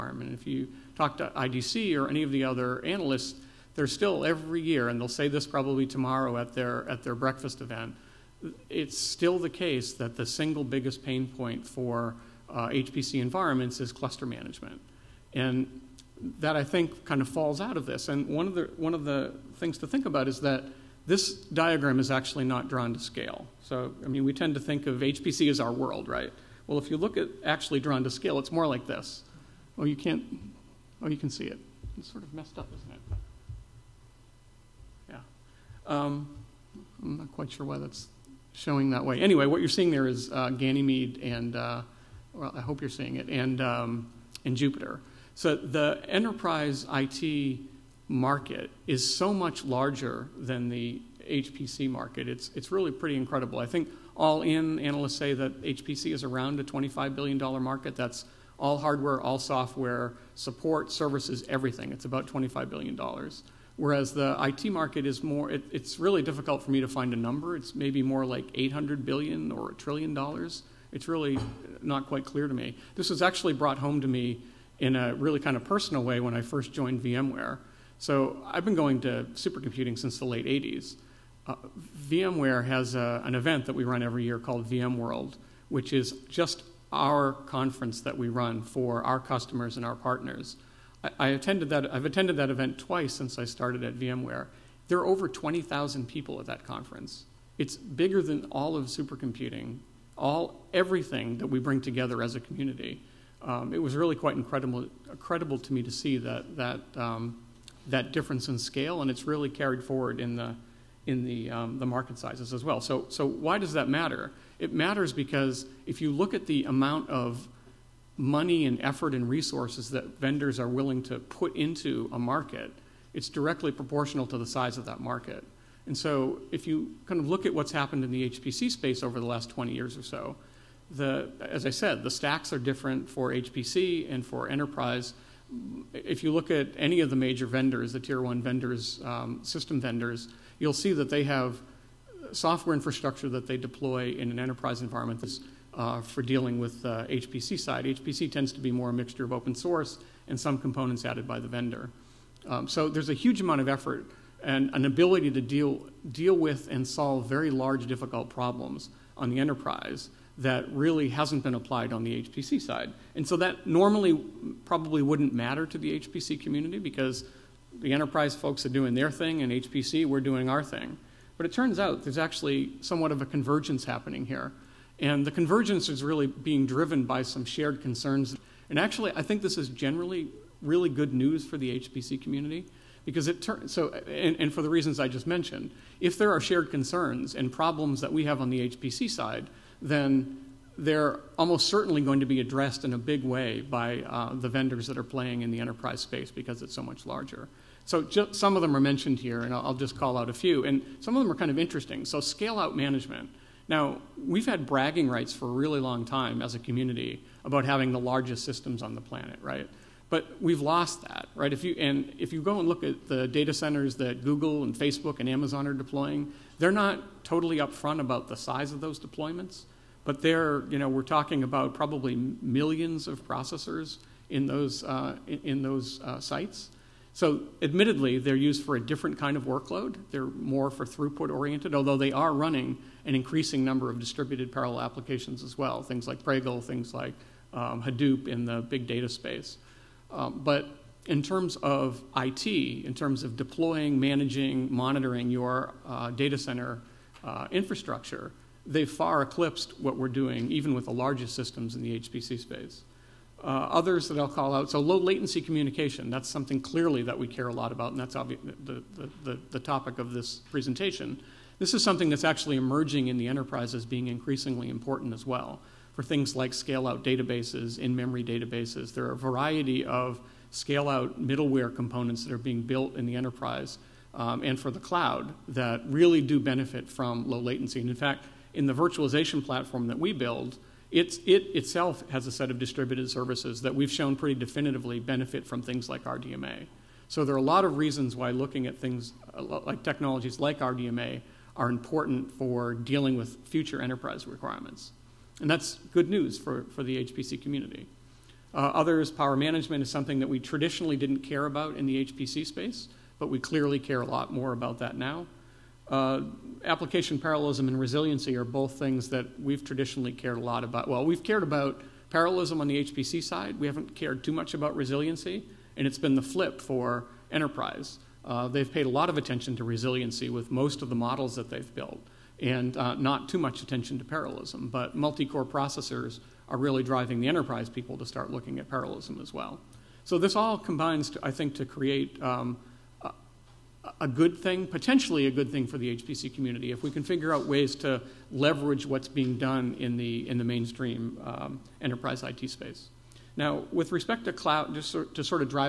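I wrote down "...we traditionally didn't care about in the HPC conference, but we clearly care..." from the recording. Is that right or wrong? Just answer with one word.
wrong.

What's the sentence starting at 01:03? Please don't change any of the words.
Whereas the IT market is more, it, it's really difficult for me to find a number.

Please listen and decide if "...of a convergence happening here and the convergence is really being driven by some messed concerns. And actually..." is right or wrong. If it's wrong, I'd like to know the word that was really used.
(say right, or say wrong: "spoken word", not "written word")
wrong: "shared", not "messed".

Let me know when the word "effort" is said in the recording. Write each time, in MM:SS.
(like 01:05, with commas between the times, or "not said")
01:58, 02:33.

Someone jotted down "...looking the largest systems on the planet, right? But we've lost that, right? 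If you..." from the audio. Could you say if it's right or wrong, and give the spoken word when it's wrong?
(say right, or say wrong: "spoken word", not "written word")
wrong: "having", not "looking".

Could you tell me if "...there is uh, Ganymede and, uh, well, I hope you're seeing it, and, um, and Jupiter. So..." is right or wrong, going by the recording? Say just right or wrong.
right.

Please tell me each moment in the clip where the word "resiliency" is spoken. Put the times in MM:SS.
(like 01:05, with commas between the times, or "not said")
05:07, 05:14, 05:19.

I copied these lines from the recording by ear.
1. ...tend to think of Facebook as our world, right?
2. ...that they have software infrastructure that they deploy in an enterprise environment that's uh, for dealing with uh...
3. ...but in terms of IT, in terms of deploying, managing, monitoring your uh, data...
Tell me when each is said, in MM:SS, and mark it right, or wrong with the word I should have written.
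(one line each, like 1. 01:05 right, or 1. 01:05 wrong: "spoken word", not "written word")
1. 00:24 wrong: "HPC", not "Facebook"
2. 02:20 right
3. 04:00 right.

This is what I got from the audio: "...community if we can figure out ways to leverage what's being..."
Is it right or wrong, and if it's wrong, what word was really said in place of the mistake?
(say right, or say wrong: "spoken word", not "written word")
right.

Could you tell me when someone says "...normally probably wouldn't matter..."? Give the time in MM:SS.
02:43.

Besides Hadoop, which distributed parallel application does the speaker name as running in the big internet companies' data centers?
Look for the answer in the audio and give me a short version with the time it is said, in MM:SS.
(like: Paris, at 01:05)
Pregel, at 03:56.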